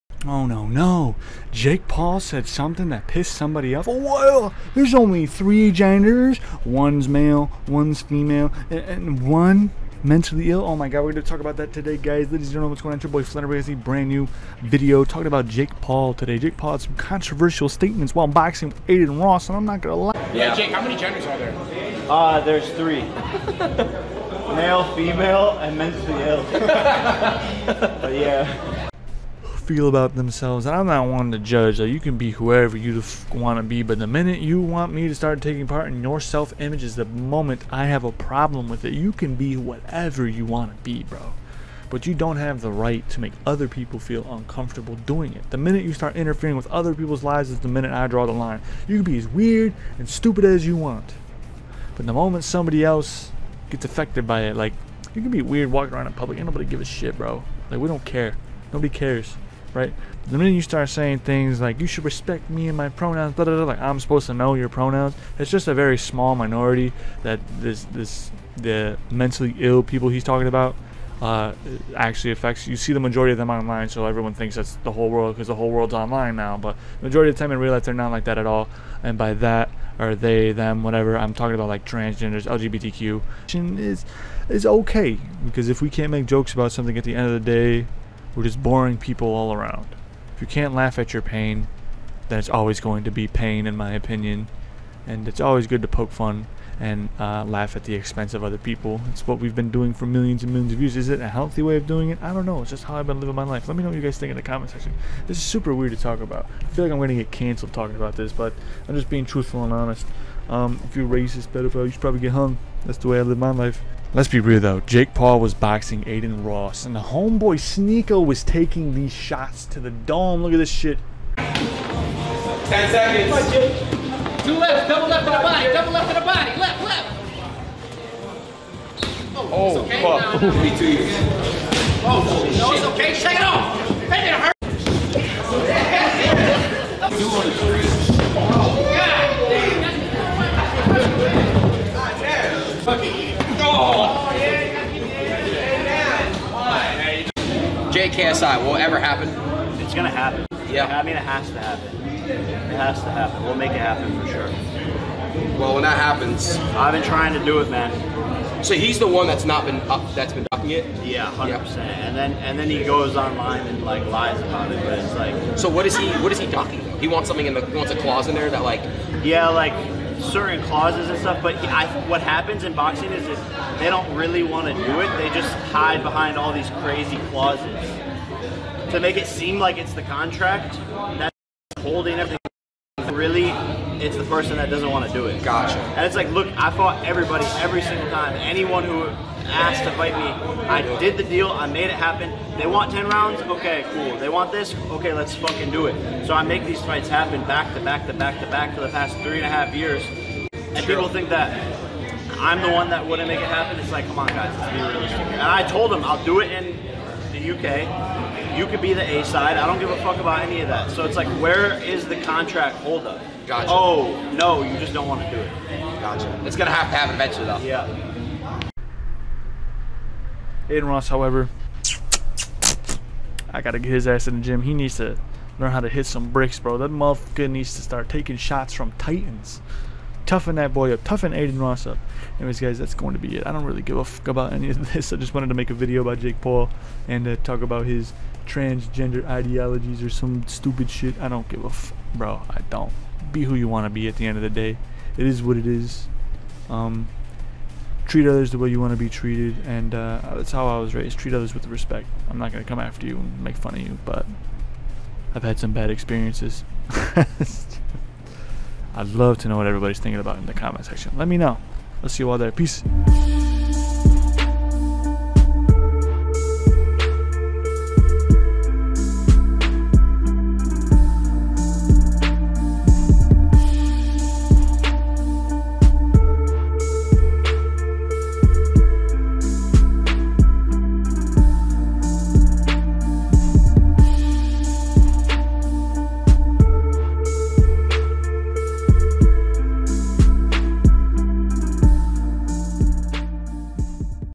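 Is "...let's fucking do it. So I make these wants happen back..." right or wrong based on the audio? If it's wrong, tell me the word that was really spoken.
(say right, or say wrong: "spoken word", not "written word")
wrong: "fights", not "wants".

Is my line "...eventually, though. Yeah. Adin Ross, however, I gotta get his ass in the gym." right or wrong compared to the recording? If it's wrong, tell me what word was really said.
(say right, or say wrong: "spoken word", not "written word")
right.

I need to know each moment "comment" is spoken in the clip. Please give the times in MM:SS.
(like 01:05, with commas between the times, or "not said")
01:44, 04:20.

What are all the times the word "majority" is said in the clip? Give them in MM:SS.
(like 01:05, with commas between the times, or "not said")
01:12, 01:17.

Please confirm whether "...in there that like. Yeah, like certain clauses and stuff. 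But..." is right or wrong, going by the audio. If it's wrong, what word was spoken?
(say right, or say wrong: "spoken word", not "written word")
right.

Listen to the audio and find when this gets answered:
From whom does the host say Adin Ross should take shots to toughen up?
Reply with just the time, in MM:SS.
03:48.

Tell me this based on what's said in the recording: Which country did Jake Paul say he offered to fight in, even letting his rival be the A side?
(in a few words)
UK.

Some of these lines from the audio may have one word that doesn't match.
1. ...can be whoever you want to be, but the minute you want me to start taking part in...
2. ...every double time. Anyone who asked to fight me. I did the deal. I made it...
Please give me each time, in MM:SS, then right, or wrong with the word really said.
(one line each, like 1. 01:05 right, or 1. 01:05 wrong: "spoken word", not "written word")
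1. 00:31 right
2. 03:07 wrong: "single", not "double".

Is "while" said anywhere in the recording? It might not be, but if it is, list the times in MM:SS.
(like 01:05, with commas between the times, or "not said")
00:18.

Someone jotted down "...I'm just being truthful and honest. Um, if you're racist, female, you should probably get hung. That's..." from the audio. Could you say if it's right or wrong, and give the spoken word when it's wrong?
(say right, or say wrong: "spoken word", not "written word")
wrong: "pedophile", not "female".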